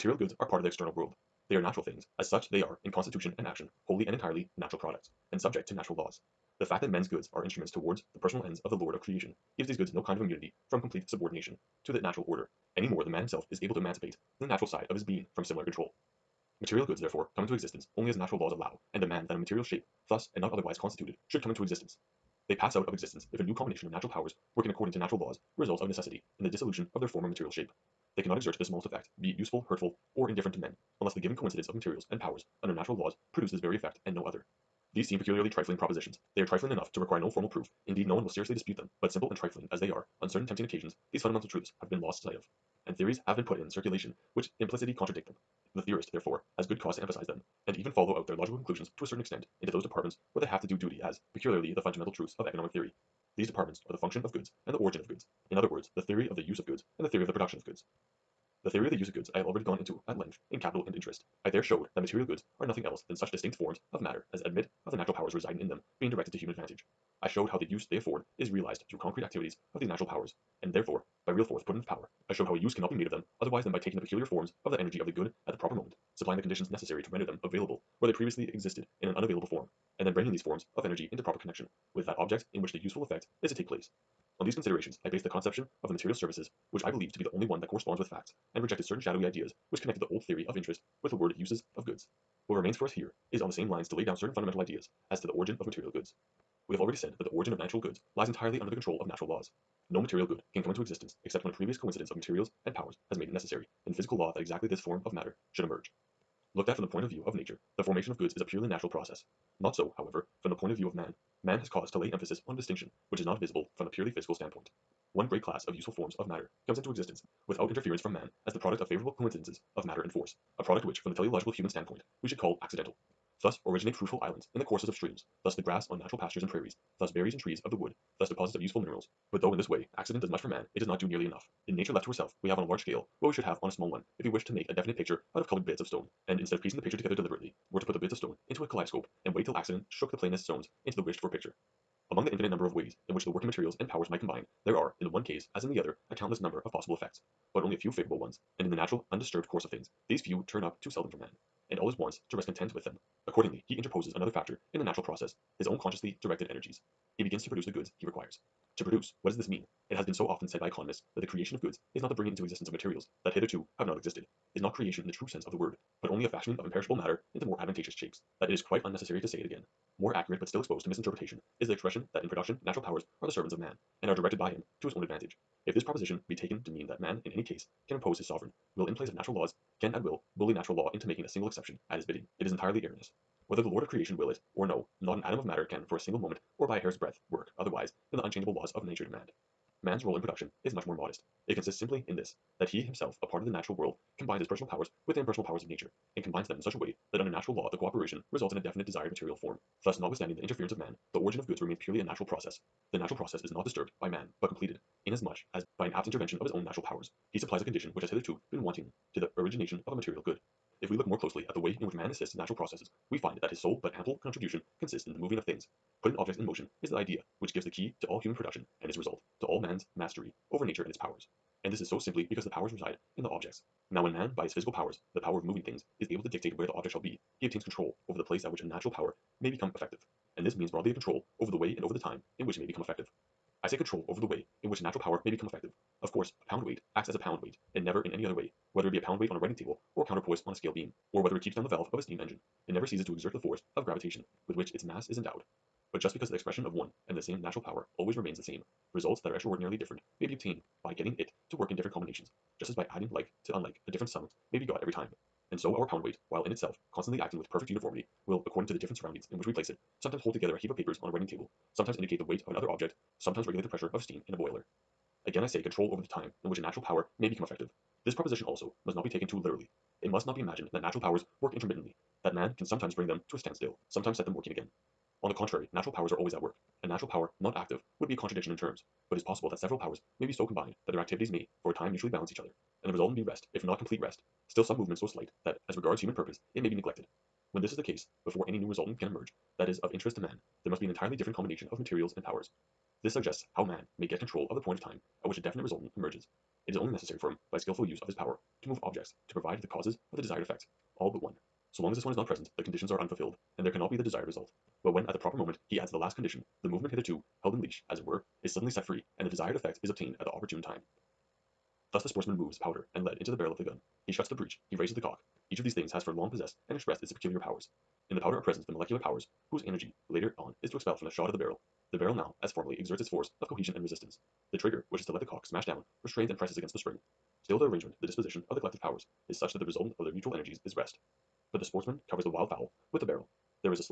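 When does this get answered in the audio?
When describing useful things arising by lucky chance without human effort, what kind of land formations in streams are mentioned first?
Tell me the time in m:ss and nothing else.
2:03.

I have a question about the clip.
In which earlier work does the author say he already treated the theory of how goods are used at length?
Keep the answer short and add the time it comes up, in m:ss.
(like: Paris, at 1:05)
Capital and Interest, at 1:00.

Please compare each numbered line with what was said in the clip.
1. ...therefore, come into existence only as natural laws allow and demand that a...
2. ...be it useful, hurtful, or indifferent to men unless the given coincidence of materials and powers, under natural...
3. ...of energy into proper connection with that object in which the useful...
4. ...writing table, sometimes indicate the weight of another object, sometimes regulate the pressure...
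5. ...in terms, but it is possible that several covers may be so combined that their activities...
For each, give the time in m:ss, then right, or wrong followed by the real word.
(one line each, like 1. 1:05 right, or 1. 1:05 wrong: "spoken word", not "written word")
1. 0:16 right
2. 0:29 right
3. 1:20 right
4. 4:21 right
5. 4:38 wrong: "powers", not "covers".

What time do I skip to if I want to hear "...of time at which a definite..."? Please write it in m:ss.
4:54.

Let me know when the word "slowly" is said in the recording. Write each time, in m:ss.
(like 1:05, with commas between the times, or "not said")
not said.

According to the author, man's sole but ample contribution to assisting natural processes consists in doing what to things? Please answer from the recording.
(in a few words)
moving of things.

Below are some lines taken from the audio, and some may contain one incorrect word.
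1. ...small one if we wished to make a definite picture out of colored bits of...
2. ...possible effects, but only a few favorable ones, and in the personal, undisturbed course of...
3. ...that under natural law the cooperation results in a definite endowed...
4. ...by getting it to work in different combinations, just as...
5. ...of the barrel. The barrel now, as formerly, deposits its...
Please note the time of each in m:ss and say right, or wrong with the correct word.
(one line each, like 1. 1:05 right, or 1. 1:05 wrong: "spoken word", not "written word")
1. 2:13 right
2. 2:26 wrong: "natural", not "personal"
3. 3:17 wrong: "desired", not "endowed"
4. 4:10 right
5. 5:21 wrong: "exerts", not "deposits".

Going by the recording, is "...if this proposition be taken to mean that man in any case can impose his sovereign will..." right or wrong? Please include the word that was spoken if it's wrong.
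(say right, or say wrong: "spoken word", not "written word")
right.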